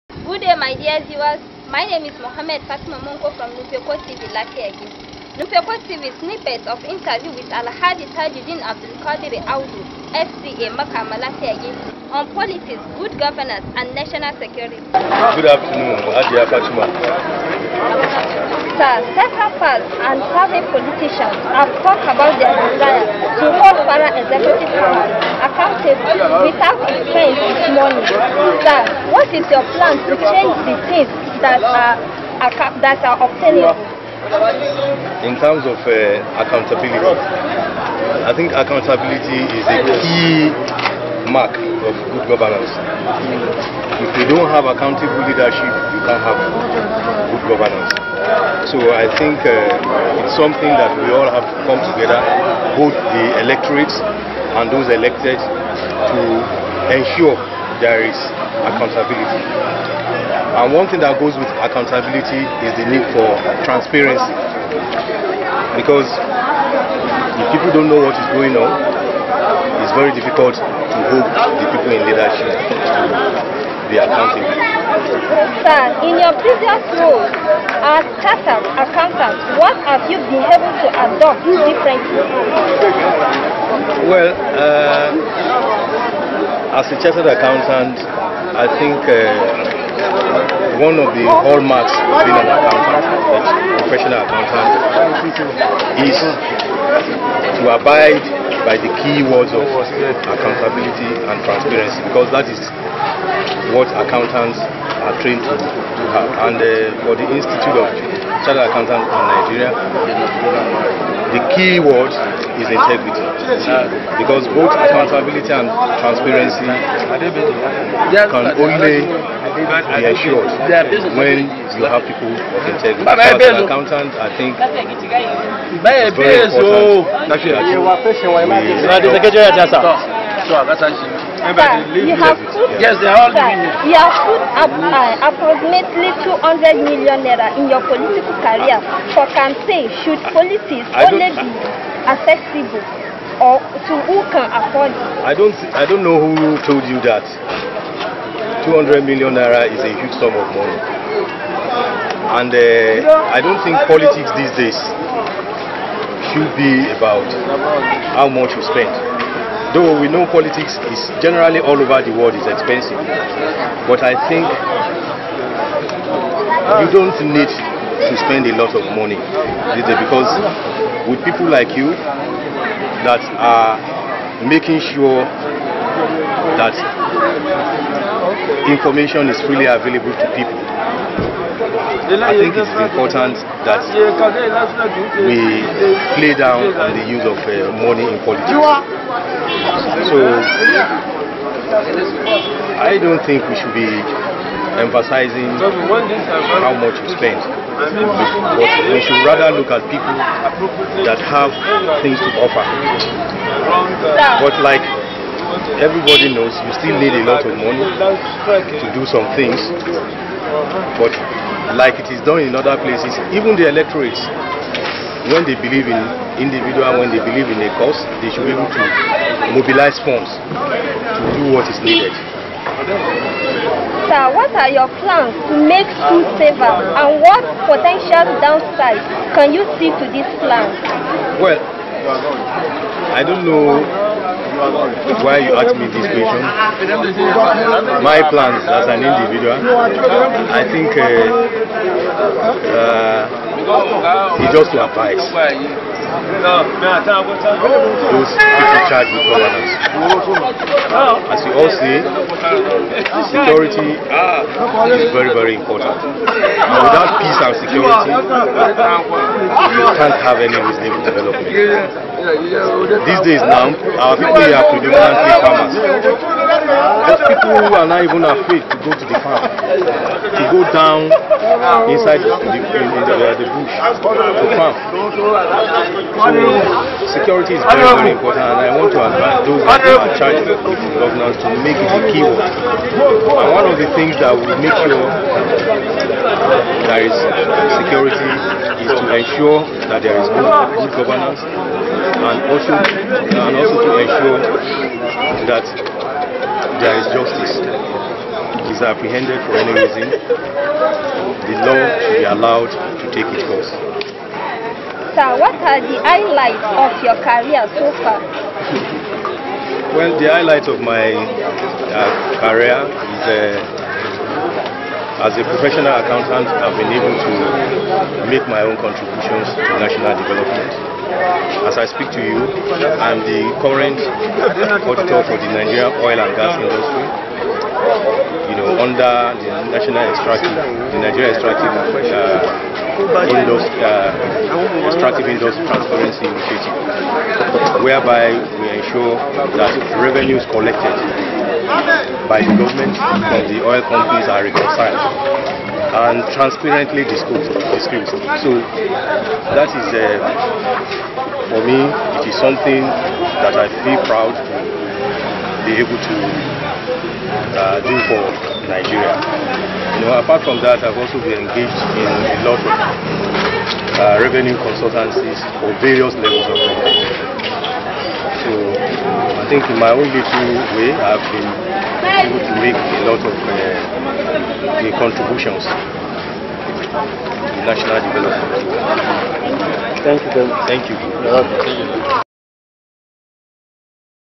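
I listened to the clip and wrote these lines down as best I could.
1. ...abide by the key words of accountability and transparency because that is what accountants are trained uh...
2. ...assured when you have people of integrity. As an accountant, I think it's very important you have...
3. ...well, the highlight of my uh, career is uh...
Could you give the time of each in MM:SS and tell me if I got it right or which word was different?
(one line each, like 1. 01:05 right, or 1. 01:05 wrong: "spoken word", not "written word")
1. 01:37 right
2. 02:00 right
3. 05:09 right.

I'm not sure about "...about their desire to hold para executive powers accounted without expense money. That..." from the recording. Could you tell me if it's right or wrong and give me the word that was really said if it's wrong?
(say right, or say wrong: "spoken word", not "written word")
right.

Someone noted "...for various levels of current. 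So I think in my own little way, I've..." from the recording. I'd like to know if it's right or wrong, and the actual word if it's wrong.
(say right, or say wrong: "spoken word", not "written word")
wrong: "government", not "current".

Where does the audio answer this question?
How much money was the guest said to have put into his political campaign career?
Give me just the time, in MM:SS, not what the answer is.
02:15.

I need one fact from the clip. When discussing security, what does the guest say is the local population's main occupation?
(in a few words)
farmers.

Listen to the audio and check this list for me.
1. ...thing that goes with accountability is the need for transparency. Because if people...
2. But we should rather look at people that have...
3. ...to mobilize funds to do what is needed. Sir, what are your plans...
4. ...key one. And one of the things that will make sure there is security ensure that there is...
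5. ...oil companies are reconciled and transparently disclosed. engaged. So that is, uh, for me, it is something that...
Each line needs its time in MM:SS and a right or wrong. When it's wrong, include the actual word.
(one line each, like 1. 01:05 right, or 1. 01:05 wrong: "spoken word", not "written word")
1. 01:00 right
2. 03:17 right
3. 03:38 right
4. 04:42 right
5. 05:43 wrong: "disclosed", not "engaged".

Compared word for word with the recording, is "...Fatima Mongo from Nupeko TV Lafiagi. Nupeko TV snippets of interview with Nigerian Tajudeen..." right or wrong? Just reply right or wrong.
wrong.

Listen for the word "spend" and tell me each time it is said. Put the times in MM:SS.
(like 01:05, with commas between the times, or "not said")
02:38, 02:48, 03:17.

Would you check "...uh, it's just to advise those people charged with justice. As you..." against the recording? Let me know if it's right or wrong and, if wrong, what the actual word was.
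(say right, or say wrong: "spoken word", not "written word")
wrong: "governance", not "justice".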